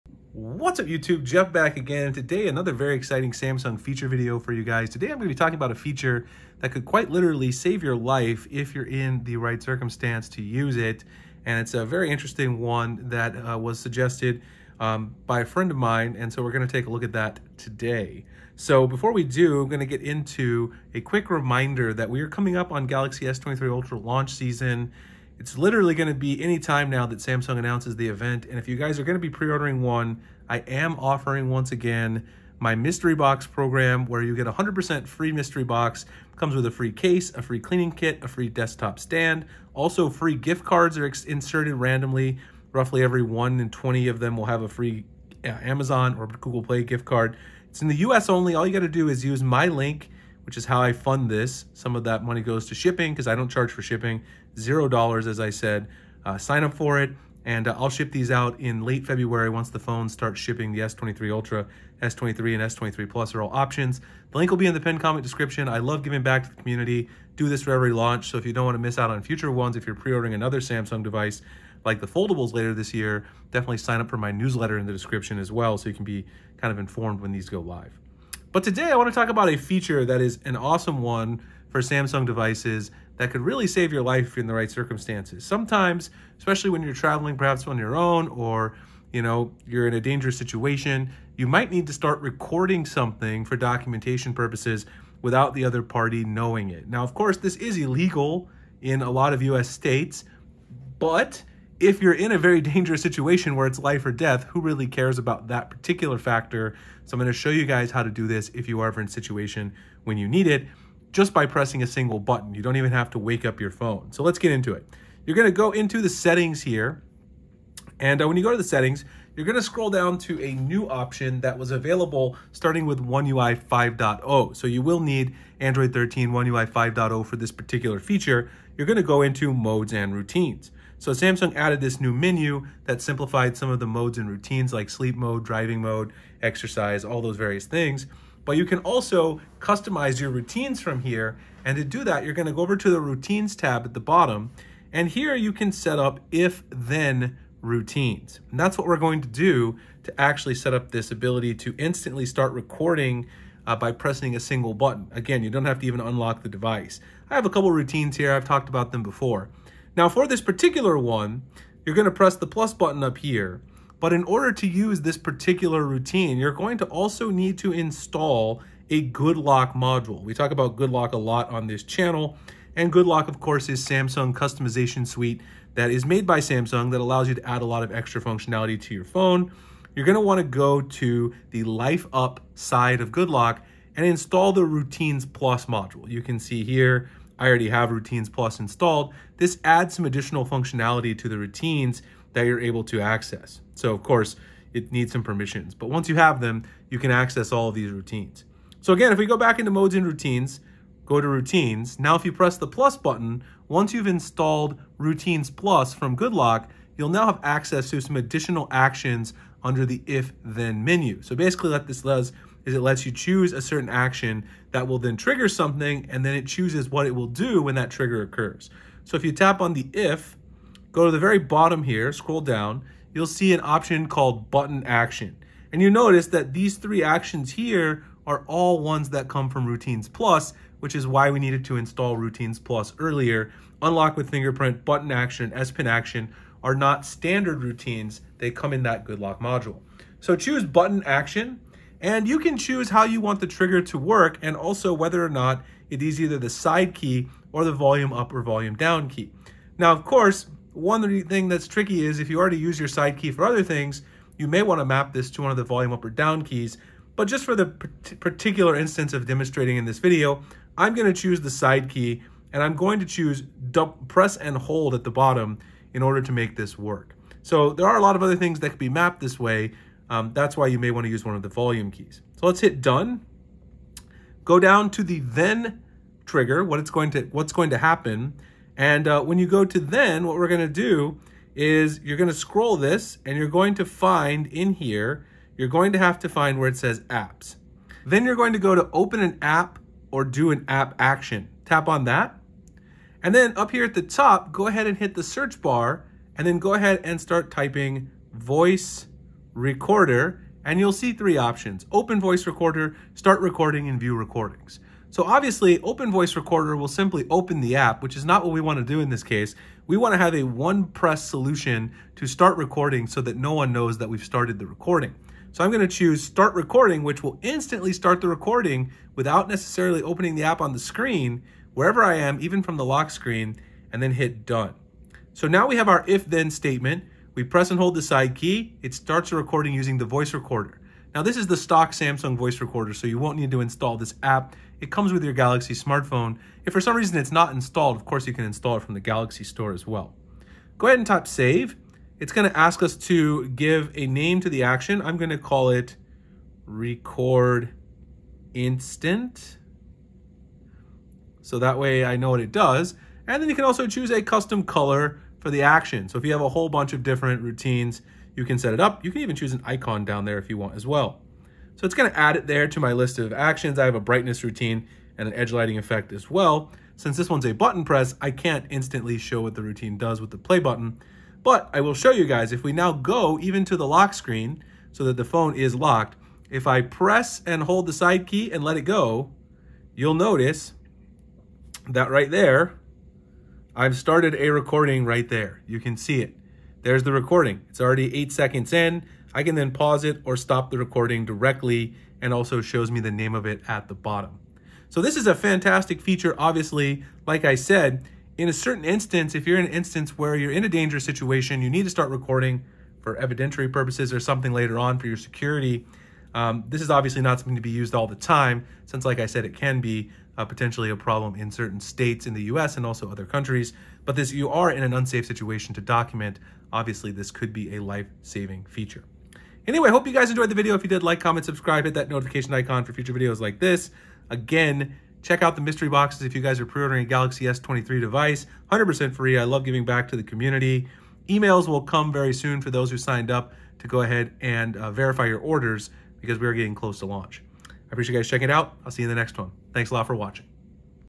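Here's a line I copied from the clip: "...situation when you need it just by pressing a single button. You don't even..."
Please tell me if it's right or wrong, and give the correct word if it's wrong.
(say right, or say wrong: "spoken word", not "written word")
right.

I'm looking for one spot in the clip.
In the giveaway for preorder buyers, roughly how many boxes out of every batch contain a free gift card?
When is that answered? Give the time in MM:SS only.
00:43.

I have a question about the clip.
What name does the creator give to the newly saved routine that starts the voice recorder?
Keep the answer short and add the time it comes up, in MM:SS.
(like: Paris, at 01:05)
Record instant, at 05:46.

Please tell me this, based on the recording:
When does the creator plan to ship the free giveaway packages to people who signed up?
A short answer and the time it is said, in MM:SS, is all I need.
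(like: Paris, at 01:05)
Late February, at 00:58.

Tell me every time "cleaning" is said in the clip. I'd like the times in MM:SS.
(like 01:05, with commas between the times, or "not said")
00:37.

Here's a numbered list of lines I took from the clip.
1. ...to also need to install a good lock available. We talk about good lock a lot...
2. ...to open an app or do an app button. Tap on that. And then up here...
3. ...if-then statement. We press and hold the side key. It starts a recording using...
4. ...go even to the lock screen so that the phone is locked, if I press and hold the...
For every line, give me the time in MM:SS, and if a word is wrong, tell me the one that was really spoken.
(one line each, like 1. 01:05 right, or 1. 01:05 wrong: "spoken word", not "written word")
1. 02:46 wrong: "module", not "available"
2. 04:48 wrong: "action", not "button"
3. 05:26 right
4. 06:12 right.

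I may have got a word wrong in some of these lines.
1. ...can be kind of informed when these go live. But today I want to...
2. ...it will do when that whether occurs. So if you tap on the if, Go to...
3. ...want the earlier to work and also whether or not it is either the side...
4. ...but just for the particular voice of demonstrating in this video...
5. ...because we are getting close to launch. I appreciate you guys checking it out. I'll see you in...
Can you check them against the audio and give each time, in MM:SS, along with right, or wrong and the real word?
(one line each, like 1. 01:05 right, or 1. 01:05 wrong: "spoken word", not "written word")
1. 01:15 right
2. 03:37 wrong: "trigger", not "whether"
3. 04:03 wrong: "trigger", not "earlier"
4. 04:17 wrong: "instance", not "voice"
5. 07:16 right.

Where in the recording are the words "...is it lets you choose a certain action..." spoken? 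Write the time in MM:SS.
03:32.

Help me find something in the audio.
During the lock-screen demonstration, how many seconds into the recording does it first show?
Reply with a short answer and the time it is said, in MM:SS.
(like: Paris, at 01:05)
8, at 06:28.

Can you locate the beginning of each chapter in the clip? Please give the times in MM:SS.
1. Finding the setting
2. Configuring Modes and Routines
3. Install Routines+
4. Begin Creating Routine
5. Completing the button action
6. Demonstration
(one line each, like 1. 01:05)
1. 01:55
2. 02:27
3. 03:07
4. 03:33
5. 04:19
6. 06:16.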